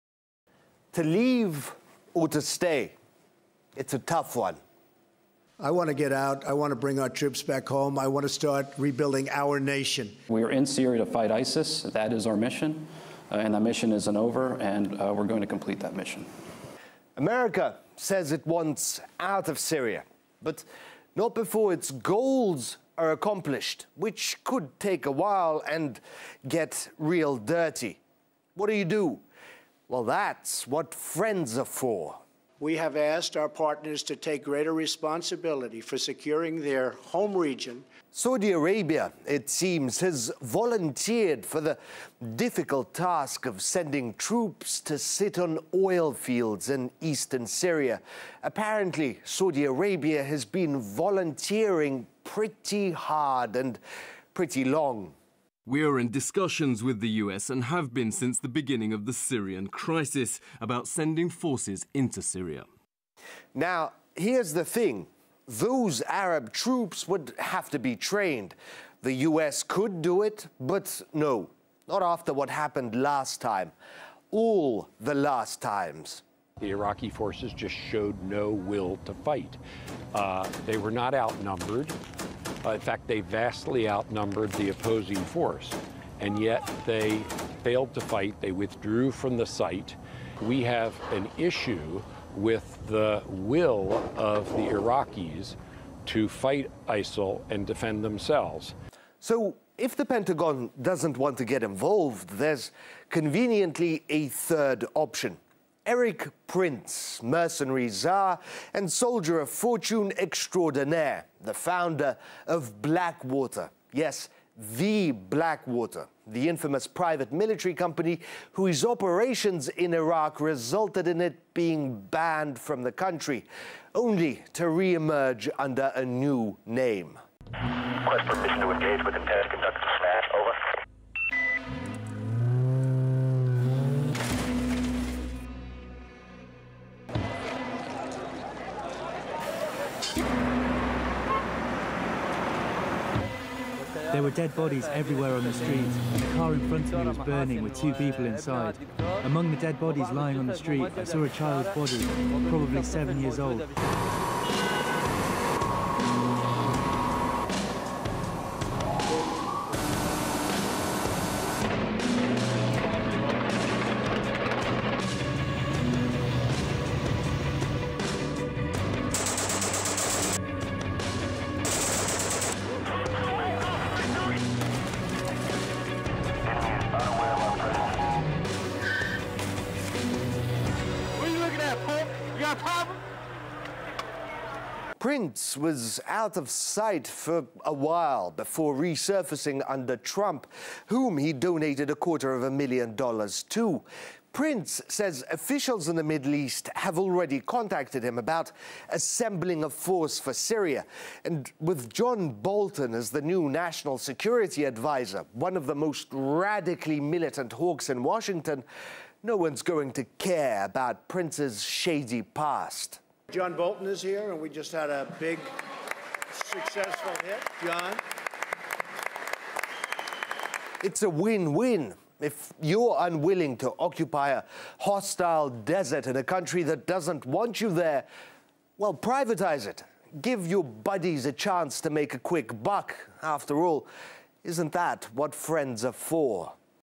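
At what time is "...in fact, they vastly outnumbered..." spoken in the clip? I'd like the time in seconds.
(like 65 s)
82 s.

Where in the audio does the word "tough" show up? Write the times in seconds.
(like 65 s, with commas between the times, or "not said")
3 s.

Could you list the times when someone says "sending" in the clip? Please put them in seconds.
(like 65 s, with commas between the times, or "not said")
43 s, 60 s.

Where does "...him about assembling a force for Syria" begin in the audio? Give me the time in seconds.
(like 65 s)
198 s.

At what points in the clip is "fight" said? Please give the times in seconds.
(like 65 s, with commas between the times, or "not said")
11 s, 79 s, 88 s, 96 s.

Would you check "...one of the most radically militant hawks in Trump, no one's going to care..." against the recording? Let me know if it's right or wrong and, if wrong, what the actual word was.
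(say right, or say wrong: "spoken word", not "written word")
wrong: "Washington", not "Trump".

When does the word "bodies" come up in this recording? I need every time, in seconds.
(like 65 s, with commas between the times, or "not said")
144 s, 149 s.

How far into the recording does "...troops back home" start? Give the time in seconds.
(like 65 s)
7 s.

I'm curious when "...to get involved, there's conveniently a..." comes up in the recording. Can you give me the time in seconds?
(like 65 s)
101 s.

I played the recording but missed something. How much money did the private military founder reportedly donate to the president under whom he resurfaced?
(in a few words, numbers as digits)
a quarter of a million dollars.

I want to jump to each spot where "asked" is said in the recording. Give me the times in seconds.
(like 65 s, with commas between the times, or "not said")
32 s.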